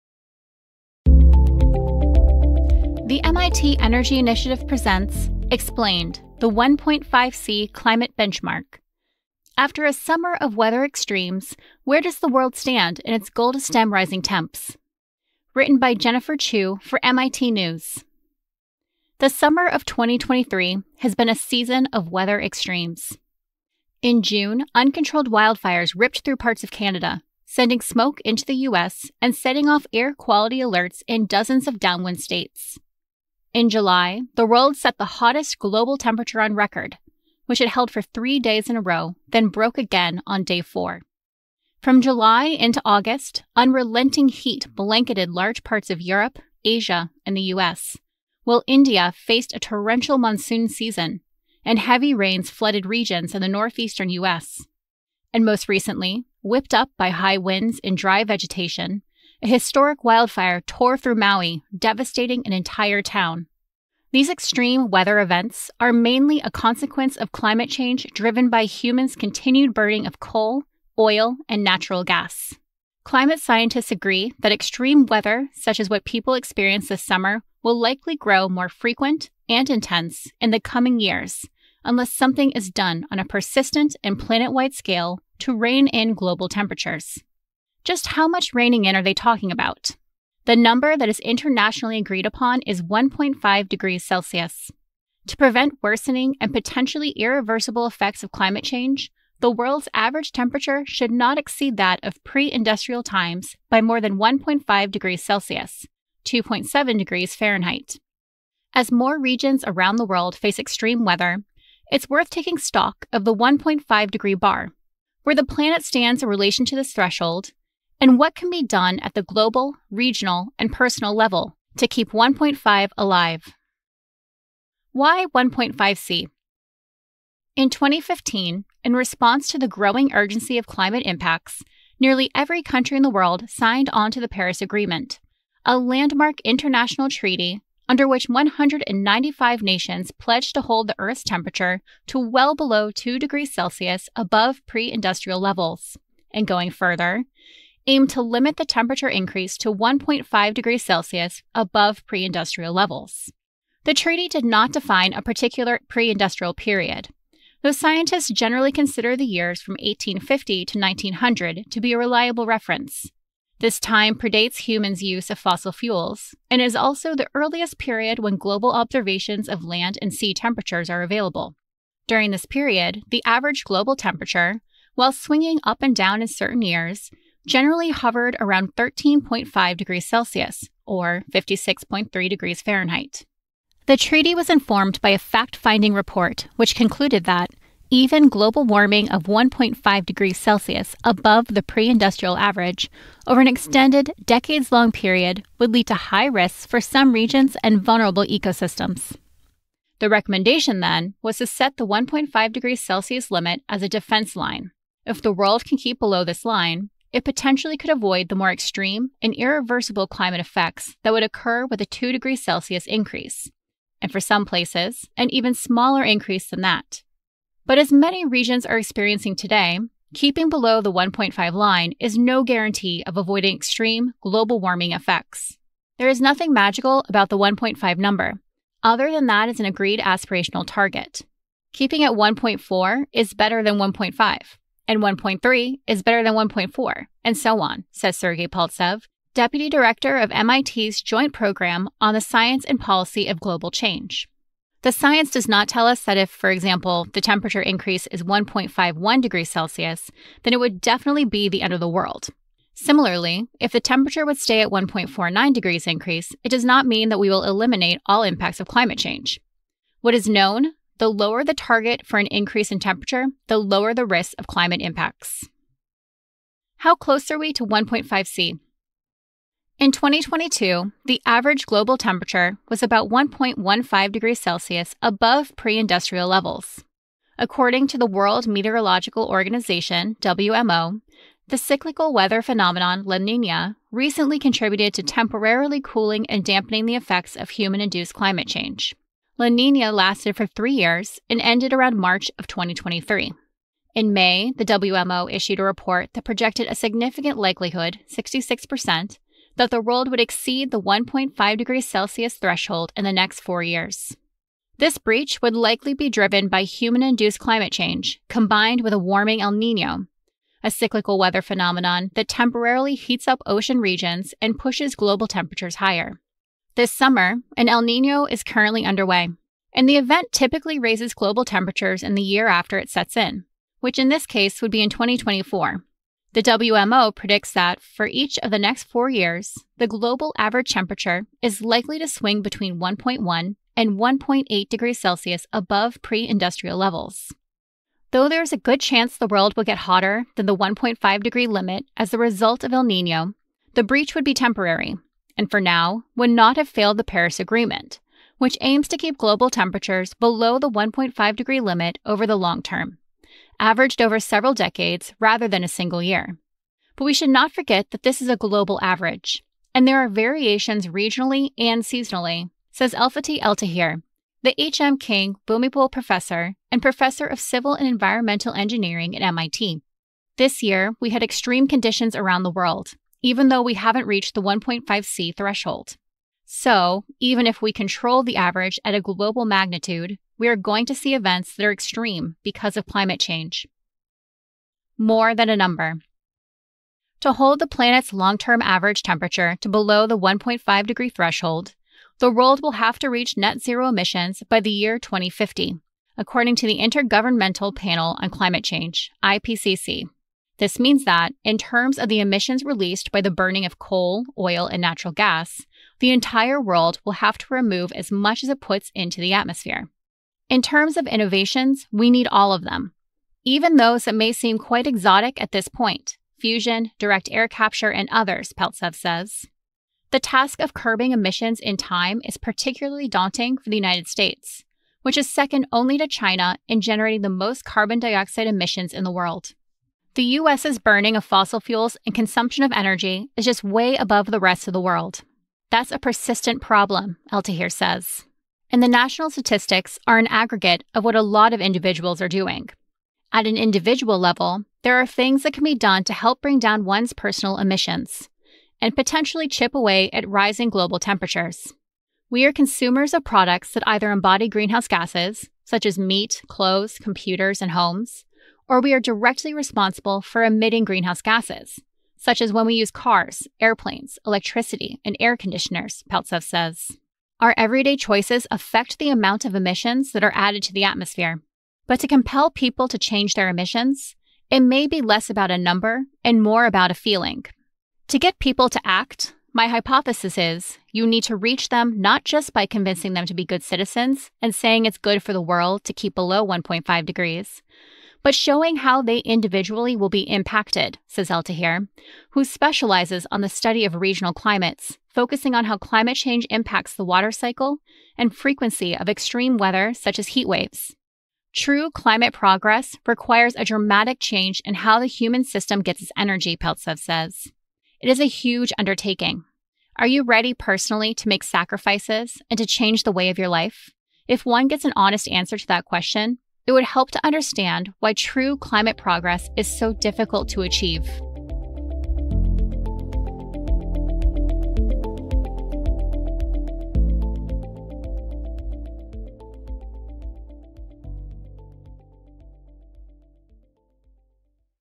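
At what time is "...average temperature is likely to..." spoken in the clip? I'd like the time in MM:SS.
05:30.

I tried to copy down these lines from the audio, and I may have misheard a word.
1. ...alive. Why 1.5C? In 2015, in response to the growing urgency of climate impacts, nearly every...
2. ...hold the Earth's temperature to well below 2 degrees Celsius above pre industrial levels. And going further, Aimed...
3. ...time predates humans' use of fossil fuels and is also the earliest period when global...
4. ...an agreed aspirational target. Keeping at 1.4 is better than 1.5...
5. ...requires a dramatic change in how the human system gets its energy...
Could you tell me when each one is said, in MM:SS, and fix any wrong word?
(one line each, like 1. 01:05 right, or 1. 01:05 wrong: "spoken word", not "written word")
1. 02:02 right
2. 02:20 right
3. 02:43 right
4. 03:49 right
5. 08:23 right.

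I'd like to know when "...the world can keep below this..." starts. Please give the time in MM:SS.
03:25.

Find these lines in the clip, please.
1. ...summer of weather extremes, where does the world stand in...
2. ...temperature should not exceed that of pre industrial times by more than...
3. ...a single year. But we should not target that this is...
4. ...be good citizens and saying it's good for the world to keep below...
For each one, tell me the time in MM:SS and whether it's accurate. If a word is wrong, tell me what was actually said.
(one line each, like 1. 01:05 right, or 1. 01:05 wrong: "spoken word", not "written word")
1. 00:09 right
2. 01:40 right
3. 05:55 wrong: "forget", not "target"
4. 08:03 right.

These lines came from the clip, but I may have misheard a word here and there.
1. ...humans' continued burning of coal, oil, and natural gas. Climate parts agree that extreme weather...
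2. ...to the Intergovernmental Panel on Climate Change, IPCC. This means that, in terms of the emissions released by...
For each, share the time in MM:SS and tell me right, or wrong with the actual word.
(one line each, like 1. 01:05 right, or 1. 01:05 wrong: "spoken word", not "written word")
1. 01:08 wrong: "scientists", not "parts"
2. 06:36 right.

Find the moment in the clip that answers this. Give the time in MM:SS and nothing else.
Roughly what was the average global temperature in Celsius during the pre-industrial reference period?
02:58.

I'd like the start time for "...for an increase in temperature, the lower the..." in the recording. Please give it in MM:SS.
04:22.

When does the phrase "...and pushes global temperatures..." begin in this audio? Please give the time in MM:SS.
05:14.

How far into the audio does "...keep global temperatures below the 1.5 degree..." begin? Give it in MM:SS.
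05:48.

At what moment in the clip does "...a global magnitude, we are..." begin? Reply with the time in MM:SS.
06:18.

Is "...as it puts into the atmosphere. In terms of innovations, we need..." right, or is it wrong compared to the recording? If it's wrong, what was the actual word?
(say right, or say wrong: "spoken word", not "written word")
right.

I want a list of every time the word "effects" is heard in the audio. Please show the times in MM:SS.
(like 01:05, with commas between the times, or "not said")
01:37, 03:30, 03:44, 04:46.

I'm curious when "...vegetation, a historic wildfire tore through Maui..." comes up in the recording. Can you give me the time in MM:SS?
00:58.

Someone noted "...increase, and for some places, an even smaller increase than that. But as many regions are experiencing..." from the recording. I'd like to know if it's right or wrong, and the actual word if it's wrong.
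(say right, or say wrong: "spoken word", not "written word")
right.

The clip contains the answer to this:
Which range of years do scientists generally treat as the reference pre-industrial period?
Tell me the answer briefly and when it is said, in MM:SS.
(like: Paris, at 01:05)
1850 to 1900, at 02:39.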